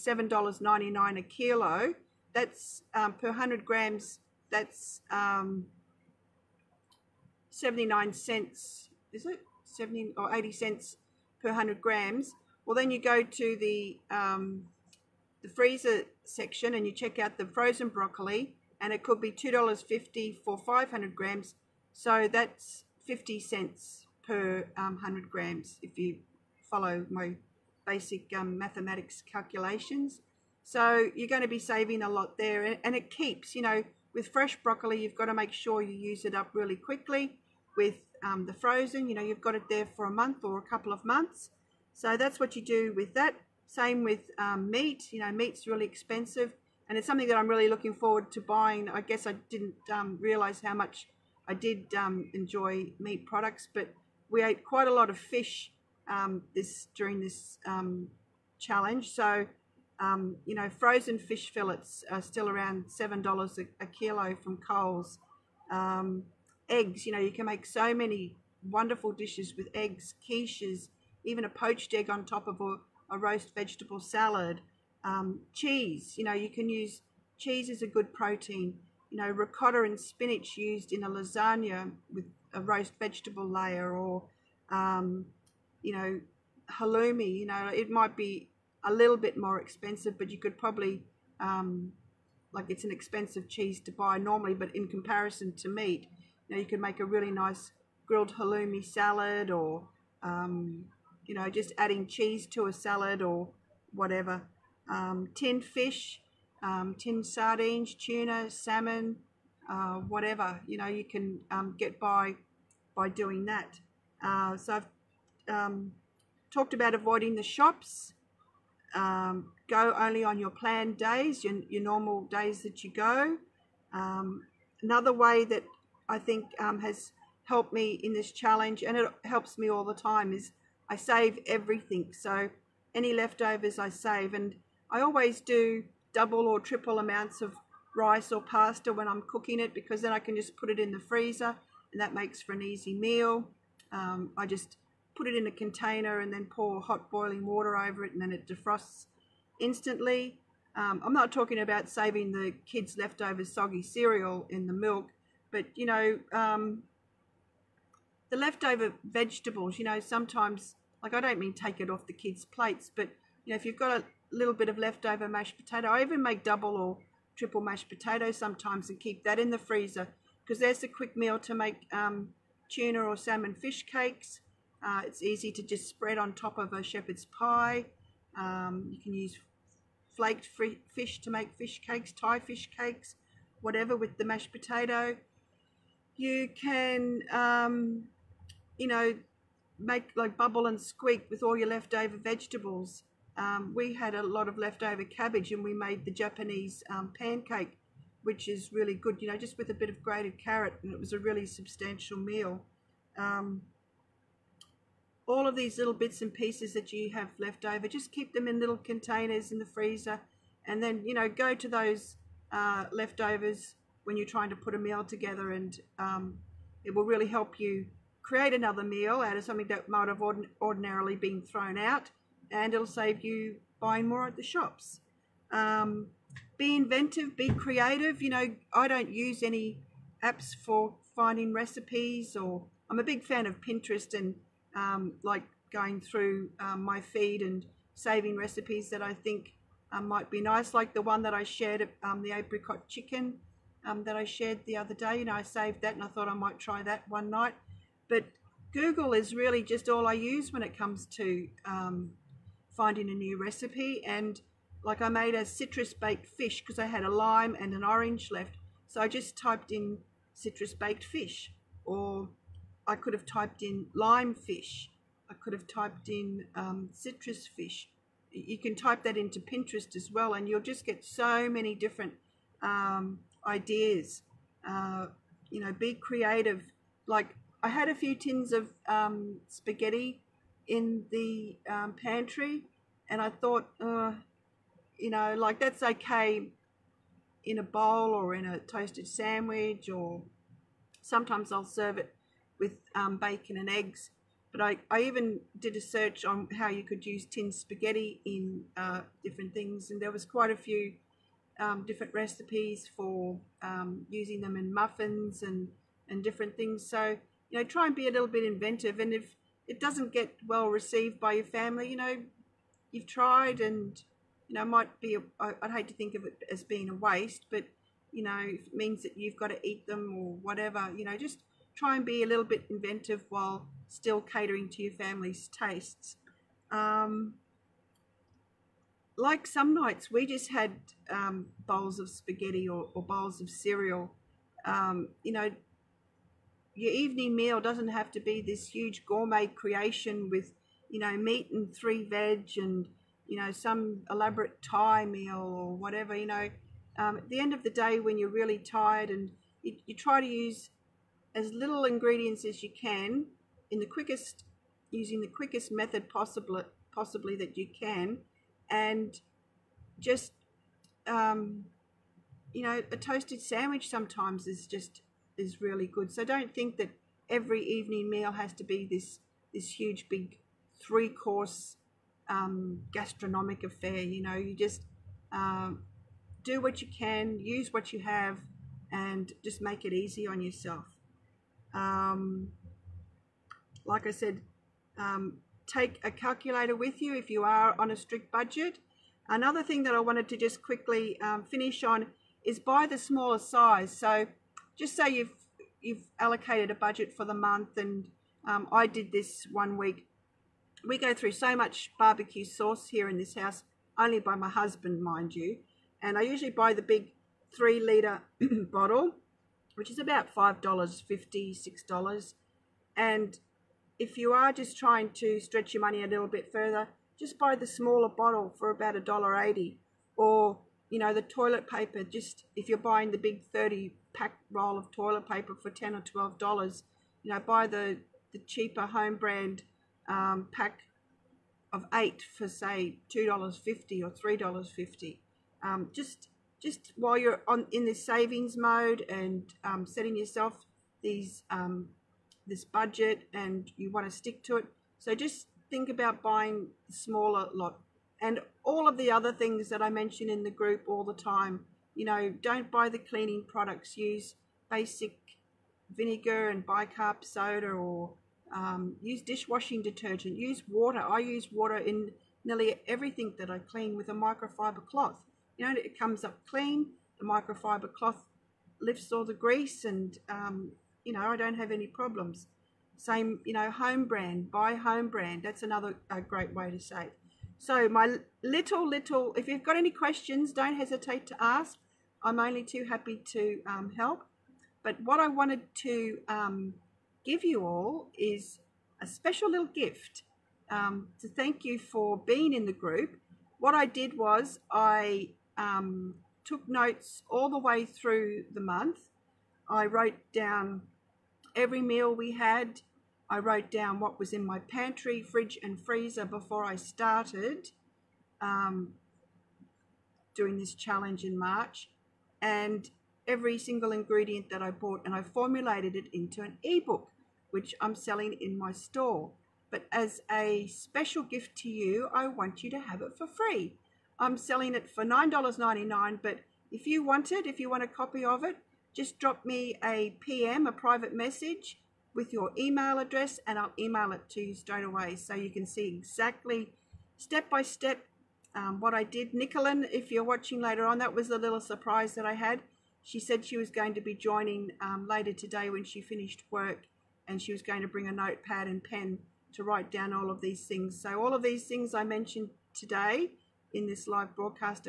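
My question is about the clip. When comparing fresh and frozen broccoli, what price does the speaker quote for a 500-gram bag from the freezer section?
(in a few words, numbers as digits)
$2.50.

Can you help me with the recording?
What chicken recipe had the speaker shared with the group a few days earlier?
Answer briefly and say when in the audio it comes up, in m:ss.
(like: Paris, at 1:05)
Apricot chicken, at 4:02.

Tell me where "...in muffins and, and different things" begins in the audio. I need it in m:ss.
5:04.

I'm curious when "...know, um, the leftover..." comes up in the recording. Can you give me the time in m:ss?
2:35.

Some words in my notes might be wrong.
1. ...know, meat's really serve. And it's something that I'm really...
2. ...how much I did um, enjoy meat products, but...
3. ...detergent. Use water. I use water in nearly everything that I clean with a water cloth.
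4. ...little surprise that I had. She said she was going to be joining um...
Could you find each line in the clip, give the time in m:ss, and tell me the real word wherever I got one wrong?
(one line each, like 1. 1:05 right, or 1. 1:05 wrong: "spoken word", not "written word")
1. 0:45 wrong: "expensive", not "serve"
2. 0:50 right
3. 7:39 wrong: "microfiber", not "water"
4. 9:01 right.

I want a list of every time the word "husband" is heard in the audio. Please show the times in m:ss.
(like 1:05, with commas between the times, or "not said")
6:44.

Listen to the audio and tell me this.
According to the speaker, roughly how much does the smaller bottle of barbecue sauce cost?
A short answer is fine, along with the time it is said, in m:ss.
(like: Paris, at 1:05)
$1.80, at 6:58.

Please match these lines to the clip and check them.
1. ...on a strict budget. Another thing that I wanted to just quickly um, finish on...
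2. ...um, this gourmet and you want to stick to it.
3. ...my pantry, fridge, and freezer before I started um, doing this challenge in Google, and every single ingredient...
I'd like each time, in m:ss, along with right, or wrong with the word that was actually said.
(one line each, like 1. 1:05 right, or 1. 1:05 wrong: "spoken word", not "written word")
1. 6:27 right
2. 7:21 wrong: "budget", not "gourmet"
3. 8:24 wrong: "March", not "Google".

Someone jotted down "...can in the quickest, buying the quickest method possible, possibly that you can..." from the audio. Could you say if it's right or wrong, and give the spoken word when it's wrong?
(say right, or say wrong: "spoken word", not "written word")
wrong: "using", not "buying".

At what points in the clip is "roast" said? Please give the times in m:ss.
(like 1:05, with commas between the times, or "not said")
1:13, 1:22.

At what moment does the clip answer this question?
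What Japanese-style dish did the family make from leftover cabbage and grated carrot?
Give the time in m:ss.
3:16.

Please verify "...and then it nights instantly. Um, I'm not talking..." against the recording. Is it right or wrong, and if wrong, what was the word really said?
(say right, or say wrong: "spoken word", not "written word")
wrong: "defrosts", not "nights".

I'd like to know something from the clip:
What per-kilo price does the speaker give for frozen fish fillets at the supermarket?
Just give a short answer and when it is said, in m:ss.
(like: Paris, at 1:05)
$7, at 1:02.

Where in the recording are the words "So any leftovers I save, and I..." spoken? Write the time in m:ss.
2:12.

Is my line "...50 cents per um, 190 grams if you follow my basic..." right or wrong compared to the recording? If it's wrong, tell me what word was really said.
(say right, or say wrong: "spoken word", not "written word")
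wrong: "100", not "190".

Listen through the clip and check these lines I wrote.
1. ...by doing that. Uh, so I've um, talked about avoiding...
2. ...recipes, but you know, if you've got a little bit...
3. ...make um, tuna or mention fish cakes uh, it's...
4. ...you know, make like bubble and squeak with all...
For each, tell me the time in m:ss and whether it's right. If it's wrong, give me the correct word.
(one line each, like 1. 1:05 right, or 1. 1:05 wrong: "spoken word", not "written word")
1. 1:52 right
2. 2:42 wrong: "plates", not "recipes"
3. 2:51 wrong: "salmon", not "mention"
4. 3:08 right.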